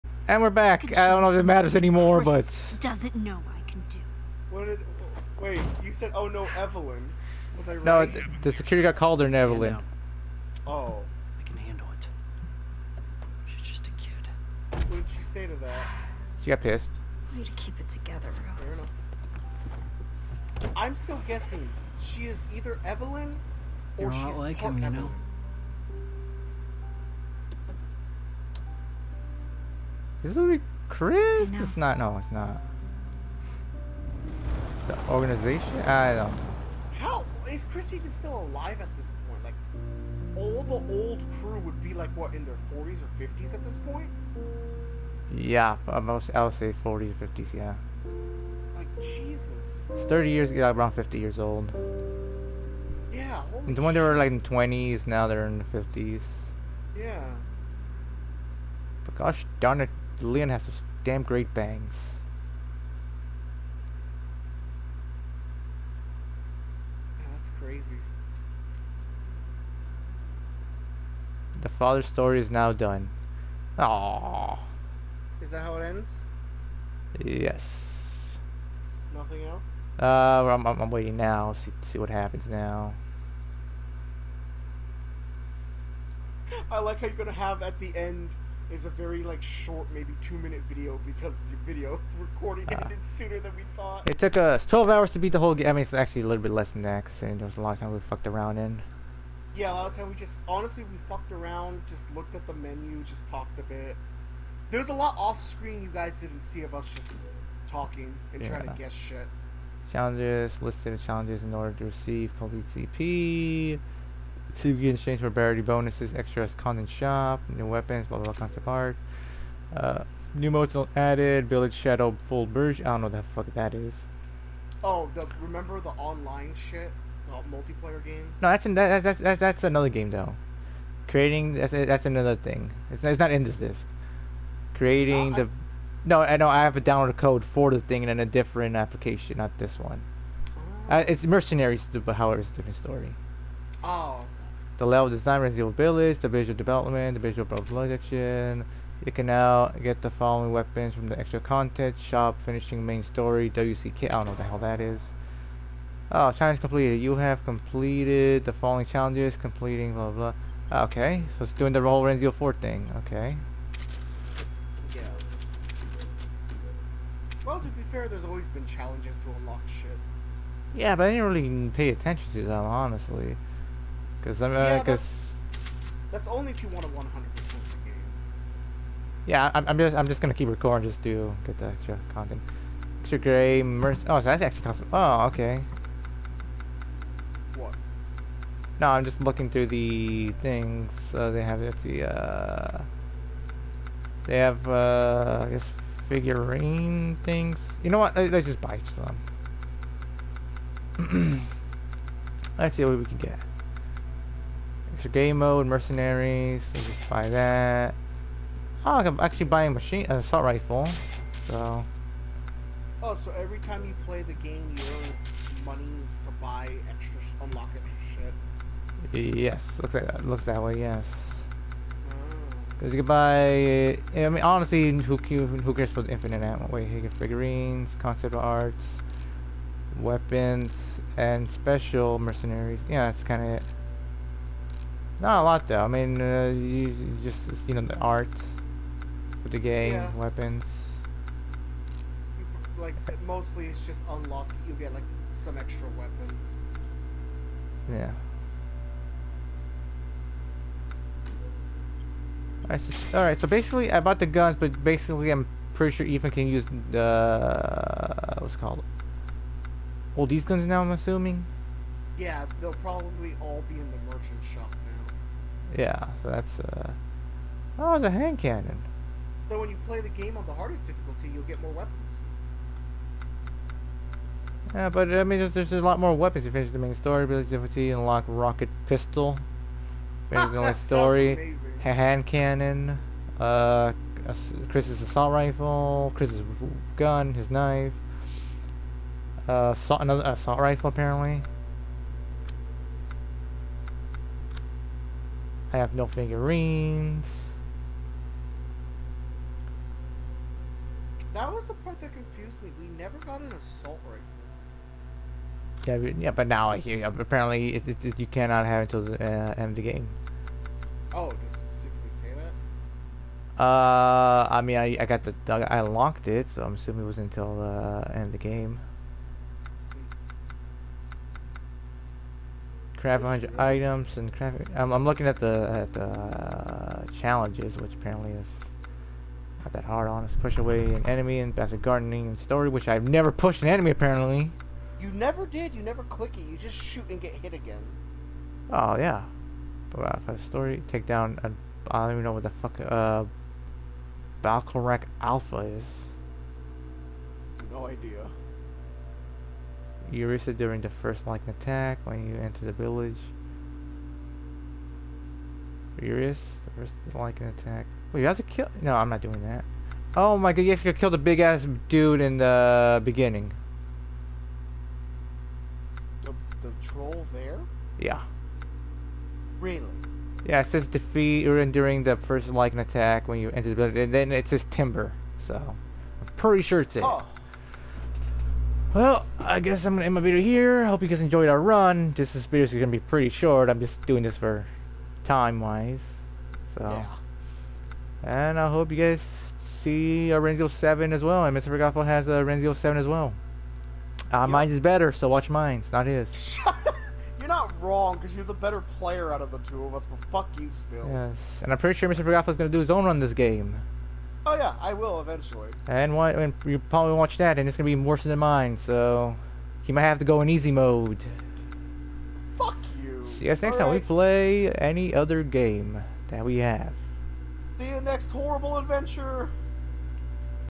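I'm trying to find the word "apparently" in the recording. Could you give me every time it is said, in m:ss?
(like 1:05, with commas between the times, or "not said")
4:50, 5:07, 5:27, 5:33.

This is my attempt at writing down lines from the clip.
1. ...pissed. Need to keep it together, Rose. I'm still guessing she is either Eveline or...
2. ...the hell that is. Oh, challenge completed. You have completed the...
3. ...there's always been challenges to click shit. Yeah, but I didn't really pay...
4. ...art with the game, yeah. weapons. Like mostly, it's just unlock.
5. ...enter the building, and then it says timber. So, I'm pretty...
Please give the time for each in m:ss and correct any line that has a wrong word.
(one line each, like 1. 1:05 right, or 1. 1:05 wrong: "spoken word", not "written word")
1. 0:16 right
2. 2:34 right
3. 2:48 wrong: "unlock", not "click"
4. 3:57 right
5. 6:13 right.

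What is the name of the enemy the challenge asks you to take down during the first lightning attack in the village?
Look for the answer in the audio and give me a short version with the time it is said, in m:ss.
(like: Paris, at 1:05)
Varcolac Alpha, at 5:44.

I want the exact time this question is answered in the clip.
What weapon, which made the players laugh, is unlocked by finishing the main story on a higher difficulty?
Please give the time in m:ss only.
4:38.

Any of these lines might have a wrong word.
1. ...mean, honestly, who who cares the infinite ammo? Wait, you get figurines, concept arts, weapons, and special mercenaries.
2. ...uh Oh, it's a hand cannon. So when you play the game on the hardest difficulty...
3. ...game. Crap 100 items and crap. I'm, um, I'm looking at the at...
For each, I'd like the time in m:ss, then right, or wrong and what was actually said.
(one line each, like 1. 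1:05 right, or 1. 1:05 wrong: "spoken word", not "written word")
1. 3:44 right
2. 4:26 right
3. 5:18 right.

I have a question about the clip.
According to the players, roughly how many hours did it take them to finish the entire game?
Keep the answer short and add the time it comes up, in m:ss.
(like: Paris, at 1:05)
12, at 1:34.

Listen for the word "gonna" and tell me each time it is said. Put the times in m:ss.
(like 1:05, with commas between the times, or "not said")
1:27, 3:00, 6:47.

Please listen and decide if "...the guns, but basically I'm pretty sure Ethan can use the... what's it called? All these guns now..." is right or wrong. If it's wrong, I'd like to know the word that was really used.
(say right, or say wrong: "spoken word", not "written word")
right.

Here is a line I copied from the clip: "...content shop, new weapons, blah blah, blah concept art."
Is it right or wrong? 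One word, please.
right.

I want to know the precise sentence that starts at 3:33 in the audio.
Oh, so every time you play the game, you earn monies to buy extra, unlock extra shit.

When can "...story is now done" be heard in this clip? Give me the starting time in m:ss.
1:12.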